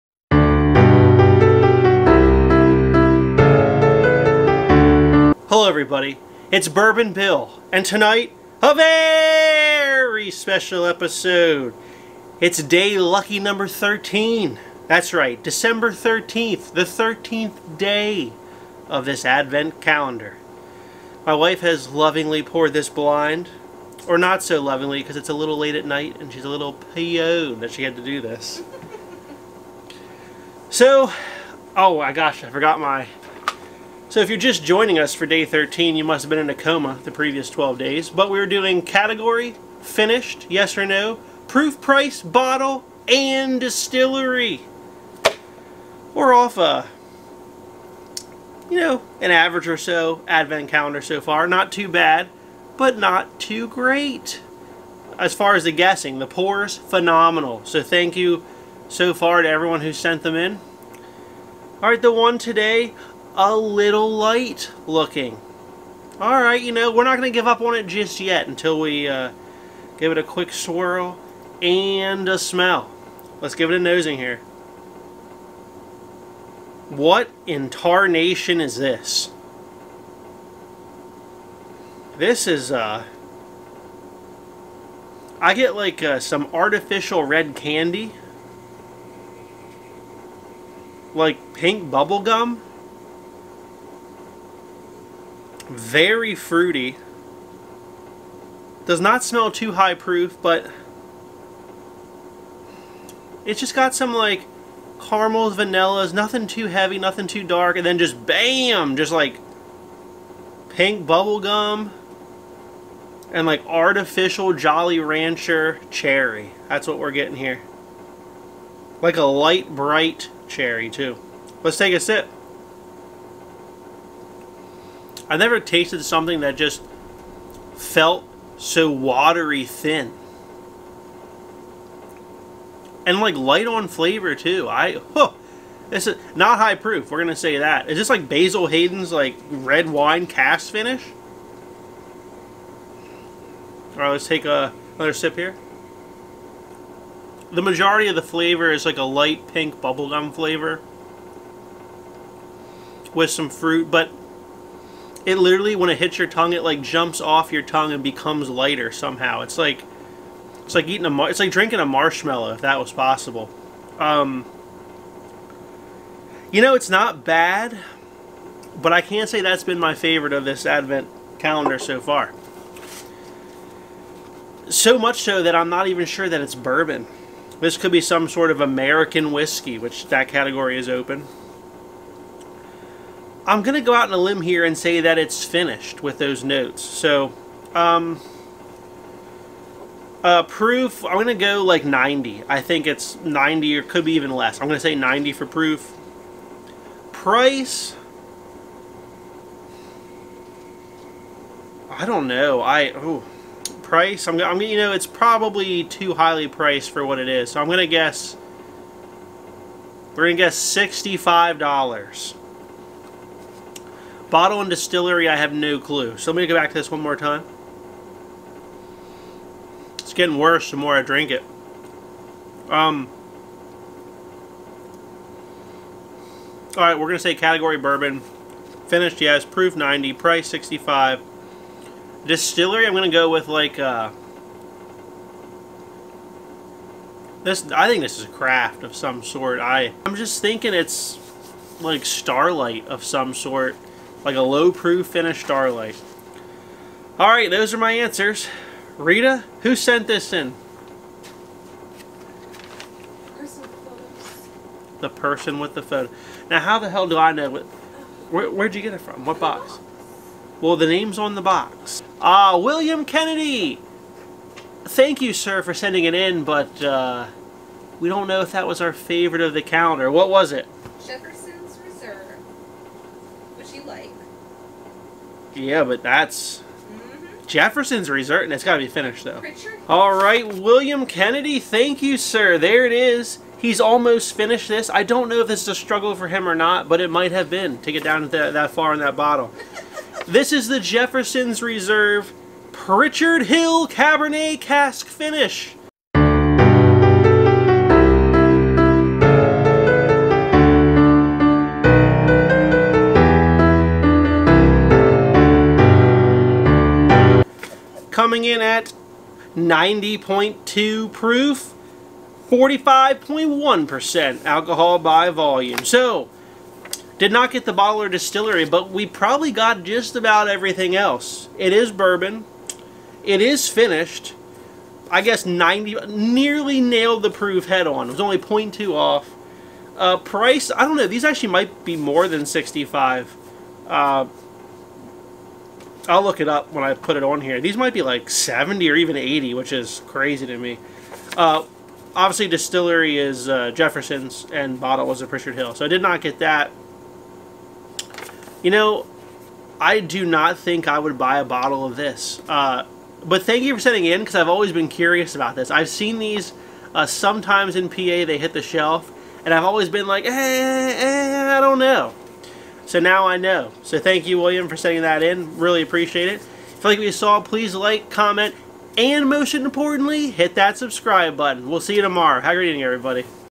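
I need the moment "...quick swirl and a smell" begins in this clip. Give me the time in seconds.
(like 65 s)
70 s.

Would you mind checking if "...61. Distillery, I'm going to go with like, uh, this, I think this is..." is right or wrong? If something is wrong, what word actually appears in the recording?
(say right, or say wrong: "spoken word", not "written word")
wrong: "65", not "61".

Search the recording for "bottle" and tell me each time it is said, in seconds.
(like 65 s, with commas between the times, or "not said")
42 s, 214 s, 289 s, 317 s, 344 s, 351 s.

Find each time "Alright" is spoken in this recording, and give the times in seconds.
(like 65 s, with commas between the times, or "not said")
66 s, 247 s.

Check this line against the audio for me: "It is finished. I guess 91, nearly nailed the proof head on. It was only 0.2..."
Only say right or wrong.
wrong.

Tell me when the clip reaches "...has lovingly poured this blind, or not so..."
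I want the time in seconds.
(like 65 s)
21 s.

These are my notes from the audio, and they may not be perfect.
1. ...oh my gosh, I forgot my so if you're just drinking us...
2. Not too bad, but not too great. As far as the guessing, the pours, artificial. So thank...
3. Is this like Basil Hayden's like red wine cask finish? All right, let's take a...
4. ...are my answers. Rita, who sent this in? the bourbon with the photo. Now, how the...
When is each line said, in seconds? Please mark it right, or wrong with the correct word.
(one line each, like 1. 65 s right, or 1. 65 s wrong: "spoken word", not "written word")
1. 31 s wrong: "joining", not "drinking"
2. 51 s wrong: "phenomenal", not "artificial"
3. 137 s right
4. 247 s wrong: "person", not "bourbon".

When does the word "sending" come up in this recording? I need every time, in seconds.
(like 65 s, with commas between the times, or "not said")
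265 s, 353 s, 364 s.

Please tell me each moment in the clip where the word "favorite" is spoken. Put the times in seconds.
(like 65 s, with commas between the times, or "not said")
169 s, 268 s.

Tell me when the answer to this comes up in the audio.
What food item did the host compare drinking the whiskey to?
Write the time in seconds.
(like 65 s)
161 s.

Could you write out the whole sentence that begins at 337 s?
These might be like 70 or even 80, which is crazy to me.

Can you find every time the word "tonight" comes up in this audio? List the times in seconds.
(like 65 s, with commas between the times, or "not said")
7 s.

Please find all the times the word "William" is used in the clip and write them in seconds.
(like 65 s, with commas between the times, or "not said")
262 s, 280 s, 364 s.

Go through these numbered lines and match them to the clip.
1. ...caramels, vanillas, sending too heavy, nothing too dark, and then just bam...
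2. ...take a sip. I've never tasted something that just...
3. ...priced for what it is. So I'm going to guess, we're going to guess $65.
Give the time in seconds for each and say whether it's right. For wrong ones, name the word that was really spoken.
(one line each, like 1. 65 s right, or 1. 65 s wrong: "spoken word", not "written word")
1. 105 s wrong: "nothing", not "sending"
2. 121 s right
3. 206 s right.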